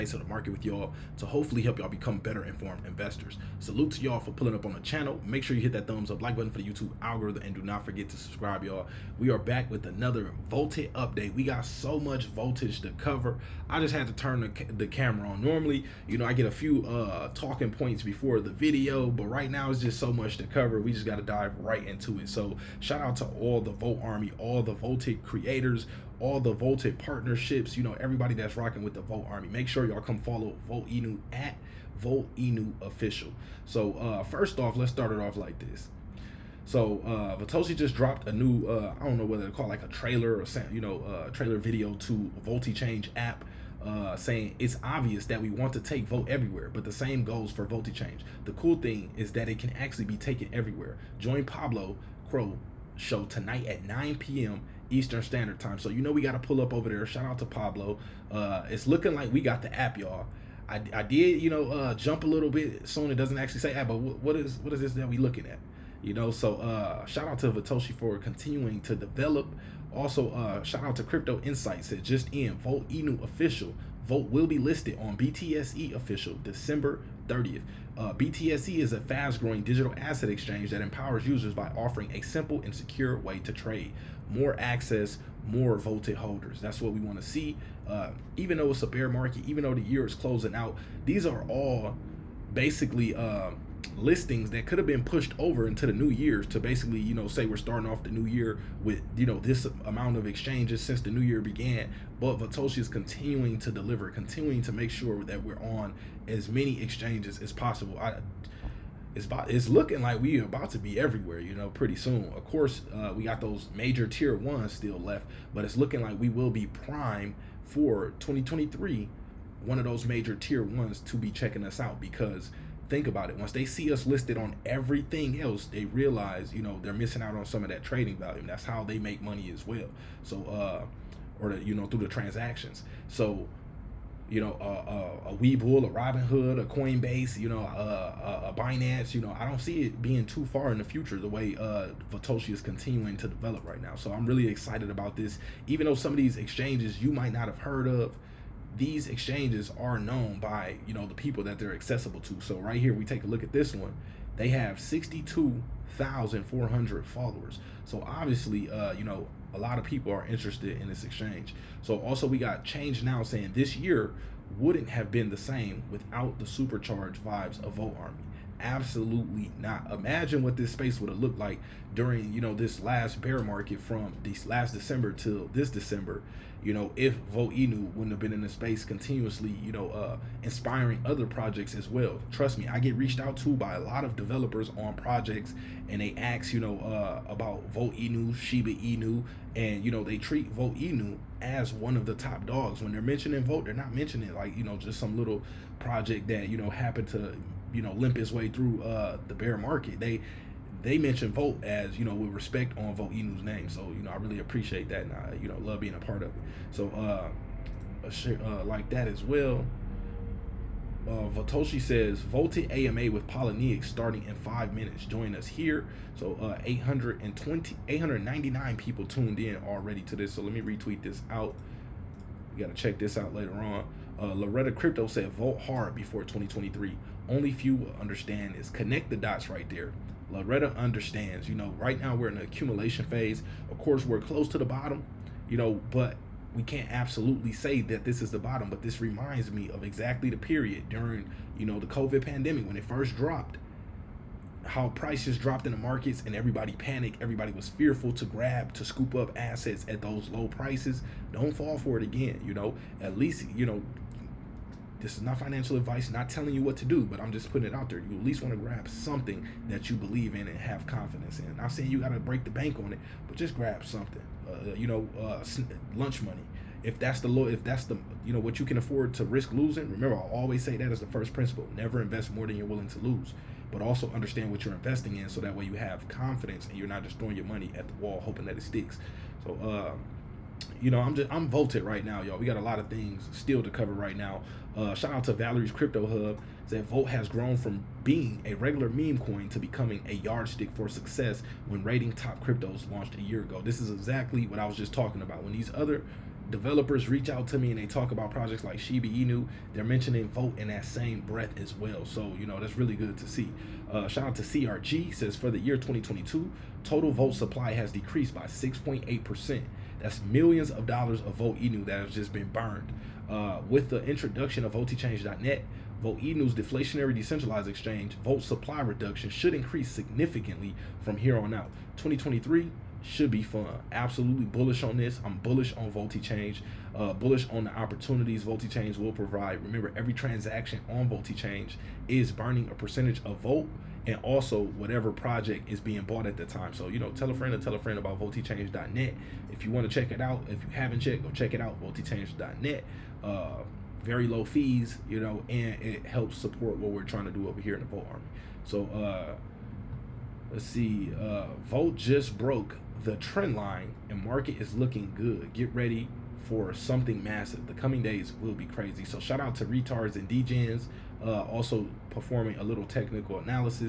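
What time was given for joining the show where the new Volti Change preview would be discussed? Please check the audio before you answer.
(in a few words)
9 p.m. Eastern.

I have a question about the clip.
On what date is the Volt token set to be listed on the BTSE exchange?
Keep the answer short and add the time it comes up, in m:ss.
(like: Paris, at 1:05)
December 30th, at 1:16.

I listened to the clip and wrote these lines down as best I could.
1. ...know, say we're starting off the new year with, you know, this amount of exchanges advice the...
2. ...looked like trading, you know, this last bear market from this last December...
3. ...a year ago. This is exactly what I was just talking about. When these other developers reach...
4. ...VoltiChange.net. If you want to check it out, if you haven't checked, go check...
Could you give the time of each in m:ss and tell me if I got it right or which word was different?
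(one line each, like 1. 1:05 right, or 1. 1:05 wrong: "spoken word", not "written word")
1. 1:37 wrong: "since", not "advice"
2. 2:51 wrong: "during", not "trading"
3. 4:53 right
4. 5:38 right.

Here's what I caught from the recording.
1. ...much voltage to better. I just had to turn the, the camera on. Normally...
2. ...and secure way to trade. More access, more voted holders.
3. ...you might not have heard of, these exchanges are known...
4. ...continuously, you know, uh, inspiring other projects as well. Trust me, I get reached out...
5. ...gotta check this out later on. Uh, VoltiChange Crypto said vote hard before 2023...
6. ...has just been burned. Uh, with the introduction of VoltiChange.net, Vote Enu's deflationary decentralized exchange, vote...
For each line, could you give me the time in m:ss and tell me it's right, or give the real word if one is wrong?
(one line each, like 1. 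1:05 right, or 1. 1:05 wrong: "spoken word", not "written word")
1. 0:12 wrong: "cover", not "better"
2. 1:22 right
3. 2:27 right
4. 2:58 right
5. 3:42 wrong: "Loretta", not "VoltiChange"
6. 5:12 right.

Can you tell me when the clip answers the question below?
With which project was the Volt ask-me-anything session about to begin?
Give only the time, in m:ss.
3:33.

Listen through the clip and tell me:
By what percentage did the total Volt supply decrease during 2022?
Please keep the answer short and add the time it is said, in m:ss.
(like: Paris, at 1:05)
6.8%, at 5:08.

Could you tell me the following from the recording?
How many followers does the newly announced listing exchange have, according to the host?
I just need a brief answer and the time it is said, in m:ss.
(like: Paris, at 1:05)
62,400, at 2:34.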